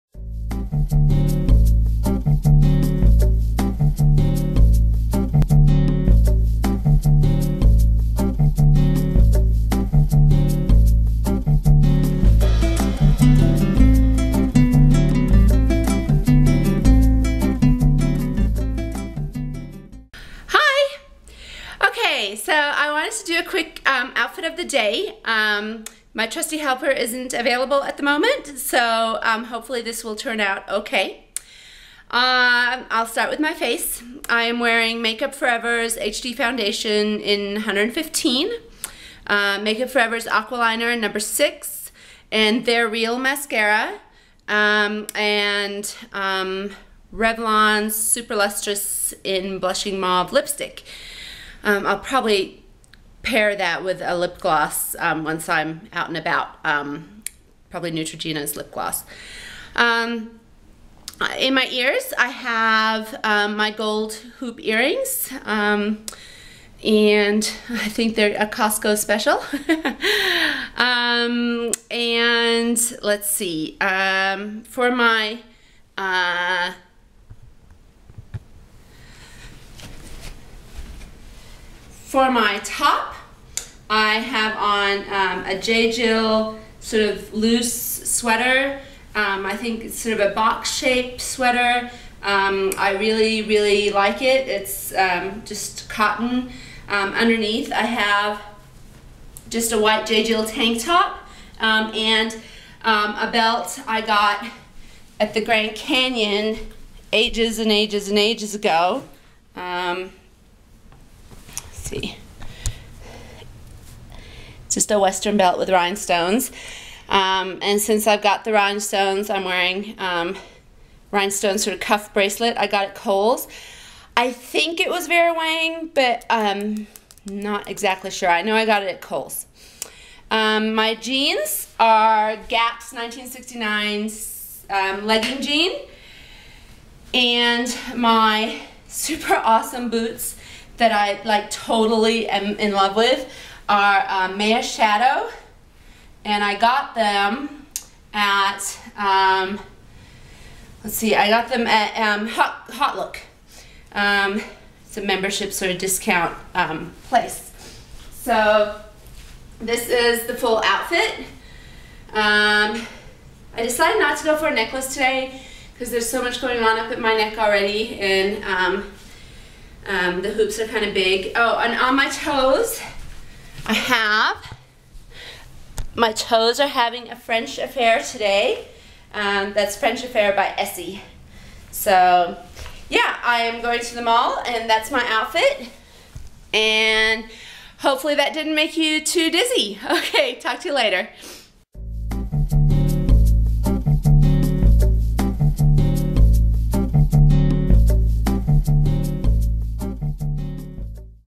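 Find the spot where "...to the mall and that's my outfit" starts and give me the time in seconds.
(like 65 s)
183 s.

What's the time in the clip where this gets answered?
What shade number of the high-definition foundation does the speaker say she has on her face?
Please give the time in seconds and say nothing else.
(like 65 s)
37 s.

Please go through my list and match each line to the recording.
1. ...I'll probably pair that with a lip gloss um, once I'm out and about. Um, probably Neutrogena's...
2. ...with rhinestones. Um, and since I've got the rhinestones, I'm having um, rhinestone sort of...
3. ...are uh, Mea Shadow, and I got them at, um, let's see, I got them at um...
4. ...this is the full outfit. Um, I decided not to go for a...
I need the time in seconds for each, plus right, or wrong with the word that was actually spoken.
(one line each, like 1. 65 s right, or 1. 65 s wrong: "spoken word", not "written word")
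1. 51 s right
2. 115 s wrong: "wearing", not "having"
3. 143 s right
4. 159 s right.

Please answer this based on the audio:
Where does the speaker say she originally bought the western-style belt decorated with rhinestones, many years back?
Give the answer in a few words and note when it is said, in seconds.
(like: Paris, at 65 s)
the Grand Canyon, at 105 s.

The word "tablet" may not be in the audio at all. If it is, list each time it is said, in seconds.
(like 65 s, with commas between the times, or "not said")
not said.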